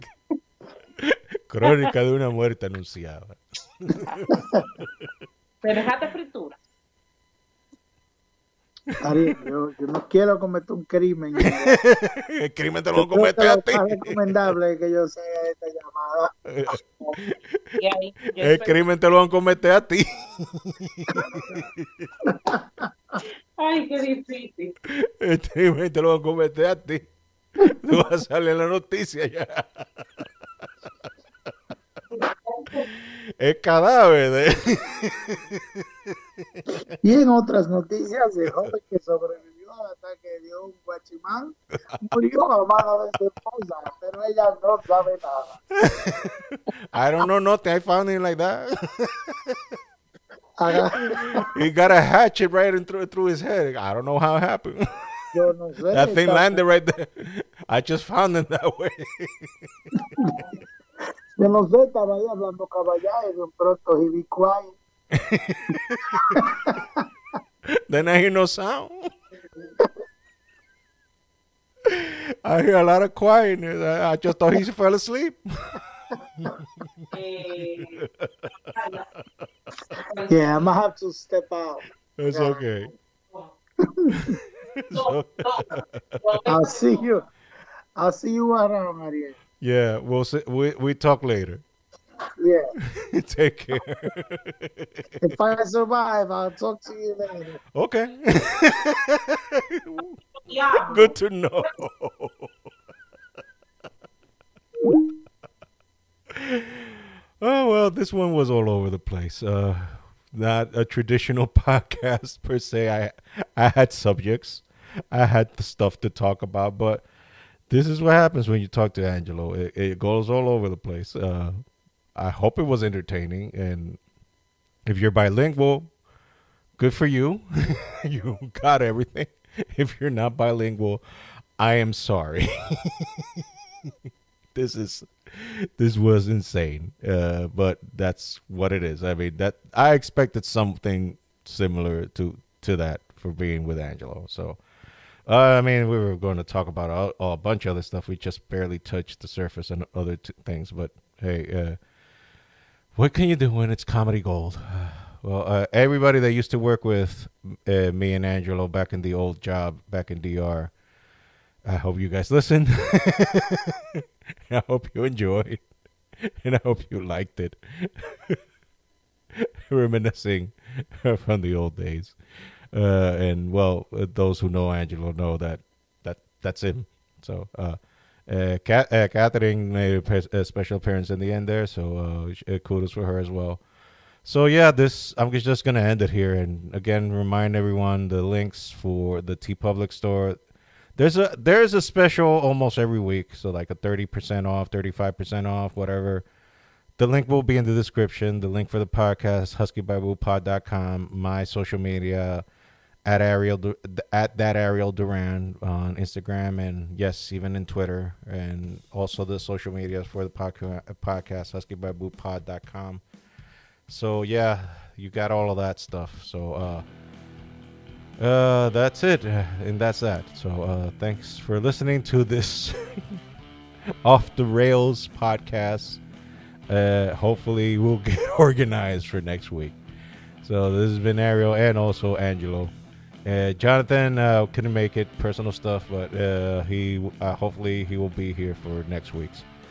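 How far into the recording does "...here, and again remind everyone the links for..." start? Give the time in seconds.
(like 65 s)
186 s.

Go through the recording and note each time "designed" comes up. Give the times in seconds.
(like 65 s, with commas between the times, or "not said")
not said.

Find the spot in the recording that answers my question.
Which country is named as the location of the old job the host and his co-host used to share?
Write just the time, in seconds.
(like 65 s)
160 s.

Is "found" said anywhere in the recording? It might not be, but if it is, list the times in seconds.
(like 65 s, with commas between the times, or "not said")
47 s, 58 s.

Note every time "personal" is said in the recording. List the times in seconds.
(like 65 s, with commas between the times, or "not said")
235 s.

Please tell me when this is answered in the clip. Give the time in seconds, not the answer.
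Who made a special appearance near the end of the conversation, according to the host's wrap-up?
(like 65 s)
179 s.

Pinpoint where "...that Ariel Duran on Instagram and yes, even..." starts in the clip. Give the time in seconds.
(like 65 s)
204 s.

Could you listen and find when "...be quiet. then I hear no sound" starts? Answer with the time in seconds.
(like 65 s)
63 s.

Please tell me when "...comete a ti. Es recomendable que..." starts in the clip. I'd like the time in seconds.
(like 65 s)
13 s.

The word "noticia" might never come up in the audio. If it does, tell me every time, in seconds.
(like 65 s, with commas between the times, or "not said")
28 s, 37 s.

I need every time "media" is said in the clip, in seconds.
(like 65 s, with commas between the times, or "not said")
201 s, 209 s.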